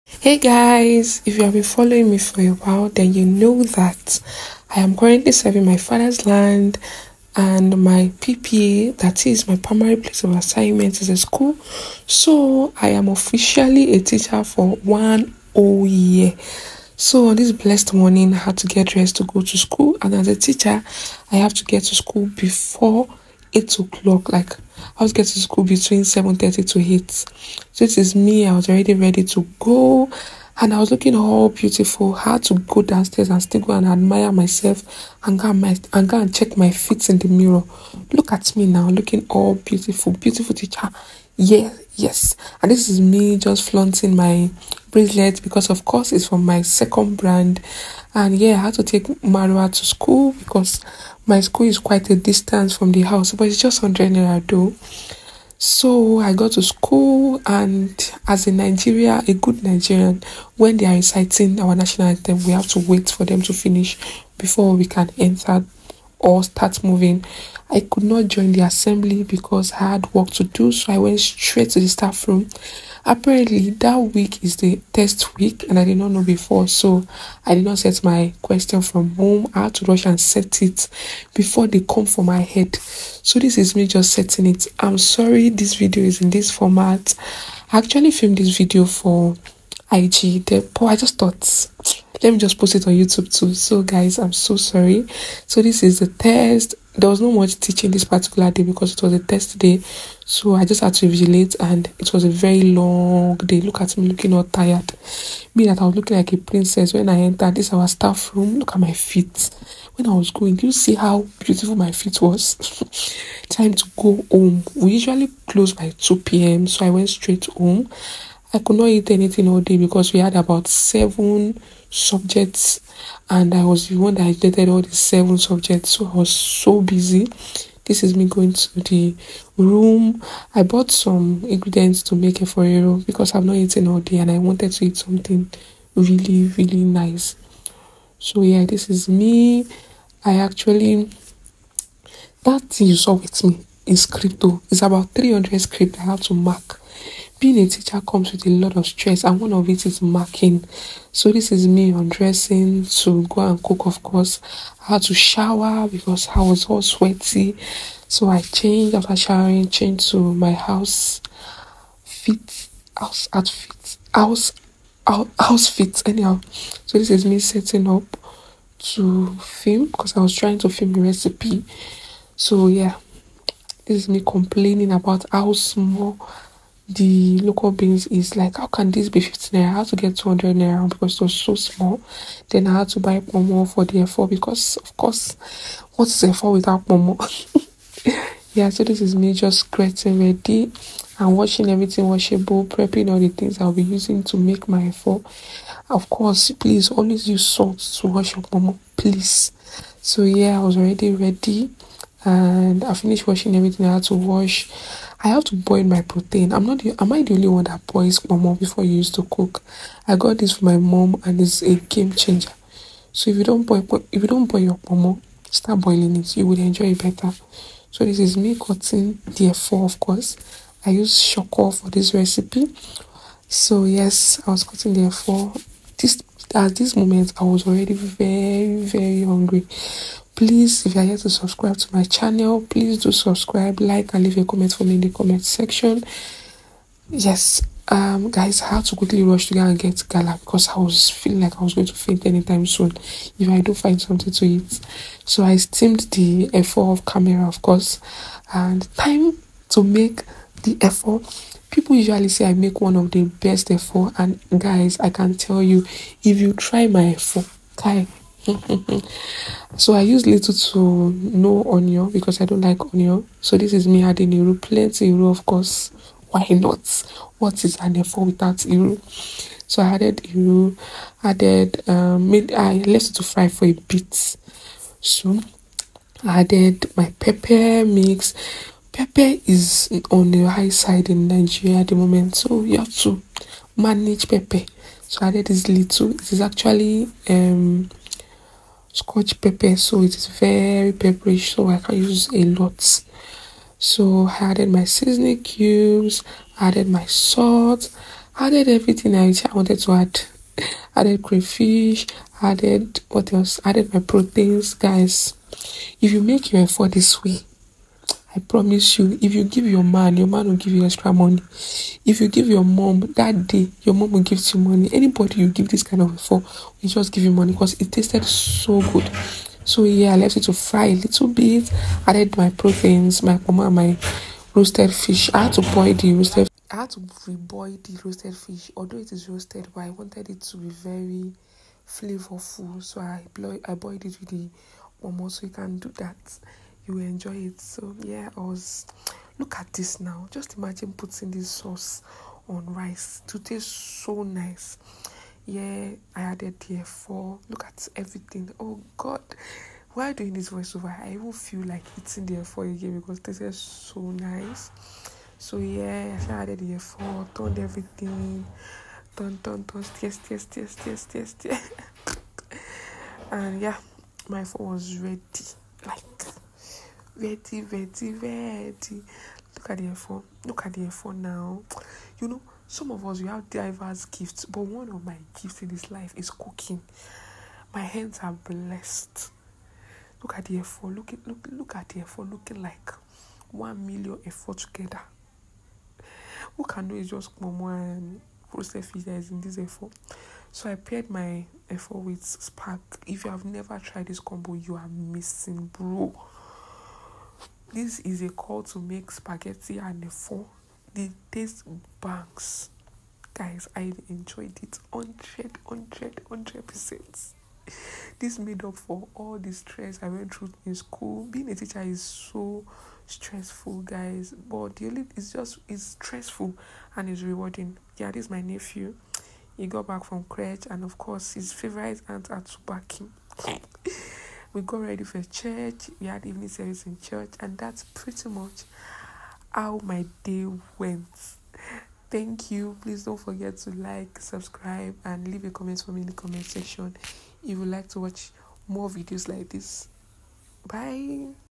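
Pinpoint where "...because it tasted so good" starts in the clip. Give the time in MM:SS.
05:17.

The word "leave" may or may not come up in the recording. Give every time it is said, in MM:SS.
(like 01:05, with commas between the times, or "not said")
03:54, 07:15.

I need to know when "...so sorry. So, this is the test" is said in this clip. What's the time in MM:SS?
01:34.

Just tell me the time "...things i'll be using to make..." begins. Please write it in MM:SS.
03:13.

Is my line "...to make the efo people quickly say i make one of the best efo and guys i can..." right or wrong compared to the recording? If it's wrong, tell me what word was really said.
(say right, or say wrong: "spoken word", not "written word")
wrong: "usually", not "quickly".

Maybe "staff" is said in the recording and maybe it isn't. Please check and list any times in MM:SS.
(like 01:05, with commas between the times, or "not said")
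01:11, 01:47.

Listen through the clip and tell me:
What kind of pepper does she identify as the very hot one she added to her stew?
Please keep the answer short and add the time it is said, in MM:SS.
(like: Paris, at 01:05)
scotch pepper, at 04:48.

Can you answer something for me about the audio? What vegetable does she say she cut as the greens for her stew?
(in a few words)
shoko.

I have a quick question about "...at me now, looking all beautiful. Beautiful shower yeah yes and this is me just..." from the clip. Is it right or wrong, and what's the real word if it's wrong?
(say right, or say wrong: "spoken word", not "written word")
wrong: "teacher", not "shower".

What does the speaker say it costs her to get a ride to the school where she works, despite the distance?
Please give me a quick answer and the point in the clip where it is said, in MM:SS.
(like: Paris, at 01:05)
100 naira, at 00:53.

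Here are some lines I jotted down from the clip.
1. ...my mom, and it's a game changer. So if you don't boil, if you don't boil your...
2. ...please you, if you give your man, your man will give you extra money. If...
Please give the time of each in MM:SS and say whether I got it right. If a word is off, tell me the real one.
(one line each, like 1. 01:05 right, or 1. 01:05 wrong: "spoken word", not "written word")
1. 03:30 right
2. 05:08 wrong: "promise", not "please".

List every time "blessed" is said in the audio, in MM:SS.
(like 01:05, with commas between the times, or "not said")
00:17, 06:18.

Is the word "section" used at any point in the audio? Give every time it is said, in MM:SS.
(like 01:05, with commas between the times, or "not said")
03:55, 07:16.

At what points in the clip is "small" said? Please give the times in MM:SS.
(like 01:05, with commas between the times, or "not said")
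02:55, 03:01.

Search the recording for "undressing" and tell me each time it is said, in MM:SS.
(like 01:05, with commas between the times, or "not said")
02:31.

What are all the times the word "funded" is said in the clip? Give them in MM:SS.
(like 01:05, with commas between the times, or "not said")
not said.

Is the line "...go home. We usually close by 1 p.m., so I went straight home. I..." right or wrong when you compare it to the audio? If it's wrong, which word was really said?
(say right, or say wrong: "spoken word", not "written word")
wrong: "2", not "1".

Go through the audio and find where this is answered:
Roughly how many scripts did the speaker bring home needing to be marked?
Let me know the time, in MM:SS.
02:25.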